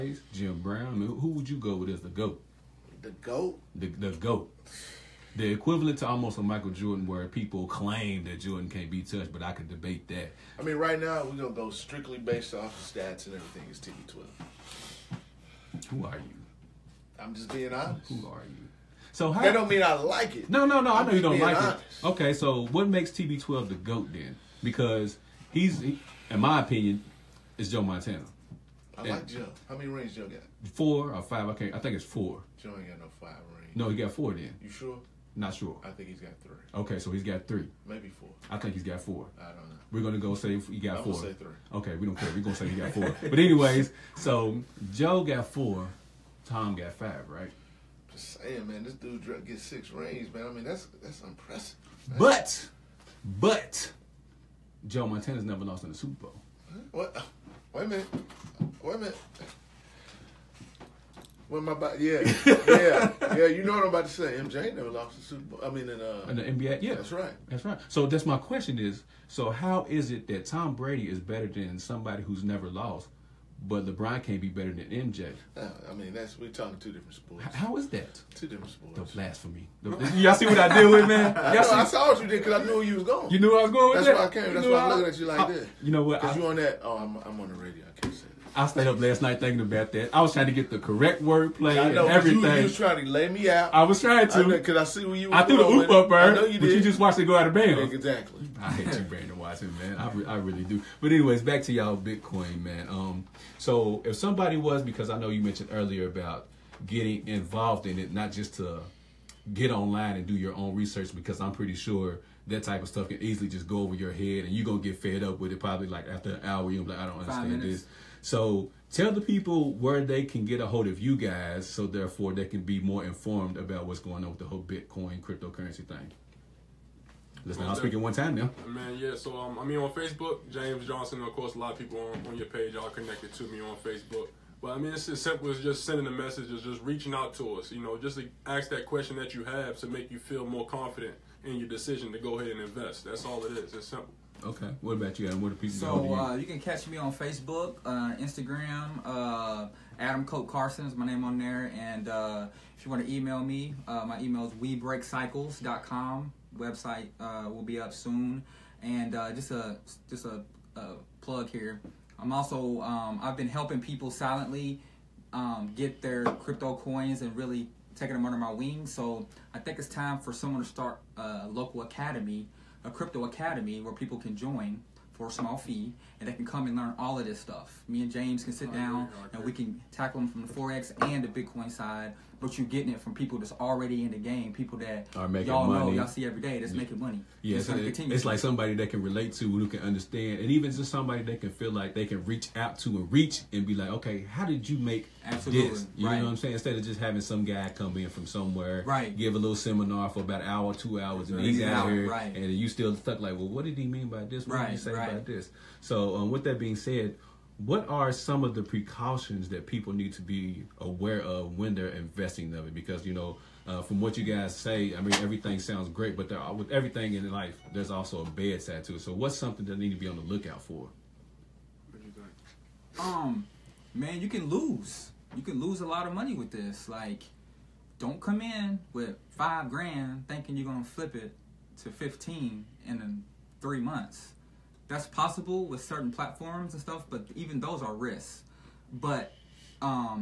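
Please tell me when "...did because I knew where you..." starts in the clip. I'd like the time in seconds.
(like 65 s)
82 s.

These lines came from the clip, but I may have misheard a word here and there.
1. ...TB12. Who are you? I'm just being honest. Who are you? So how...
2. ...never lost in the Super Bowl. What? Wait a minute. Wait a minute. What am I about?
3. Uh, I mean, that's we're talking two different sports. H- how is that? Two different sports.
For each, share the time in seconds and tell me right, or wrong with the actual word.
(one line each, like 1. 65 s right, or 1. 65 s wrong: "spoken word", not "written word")
1. 13 s right
2. 55 s right
3. 75 s right.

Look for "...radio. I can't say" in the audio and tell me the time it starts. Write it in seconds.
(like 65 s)
87 s.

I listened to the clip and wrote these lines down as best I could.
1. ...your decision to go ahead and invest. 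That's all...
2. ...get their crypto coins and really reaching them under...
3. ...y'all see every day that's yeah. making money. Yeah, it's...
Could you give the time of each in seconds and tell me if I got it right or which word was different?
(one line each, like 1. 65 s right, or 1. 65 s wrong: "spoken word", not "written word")
1. 141 s right
2. 165 s wrong: "taking", not "reaching"
3. 185 s right.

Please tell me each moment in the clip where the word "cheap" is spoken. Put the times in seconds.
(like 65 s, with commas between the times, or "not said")
not said.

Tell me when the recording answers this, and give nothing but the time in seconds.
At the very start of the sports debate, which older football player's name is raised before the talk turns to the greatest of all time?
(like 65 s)
0 s.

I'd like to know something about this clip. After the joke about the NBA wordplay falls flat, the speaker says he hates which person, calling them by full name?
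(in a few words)
Brandon Watson.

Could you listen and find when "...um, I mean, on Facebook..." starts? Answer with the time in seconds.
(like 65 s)
129 s.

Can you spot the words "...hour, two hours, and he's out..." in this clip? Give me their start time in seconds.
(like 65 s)
200 s.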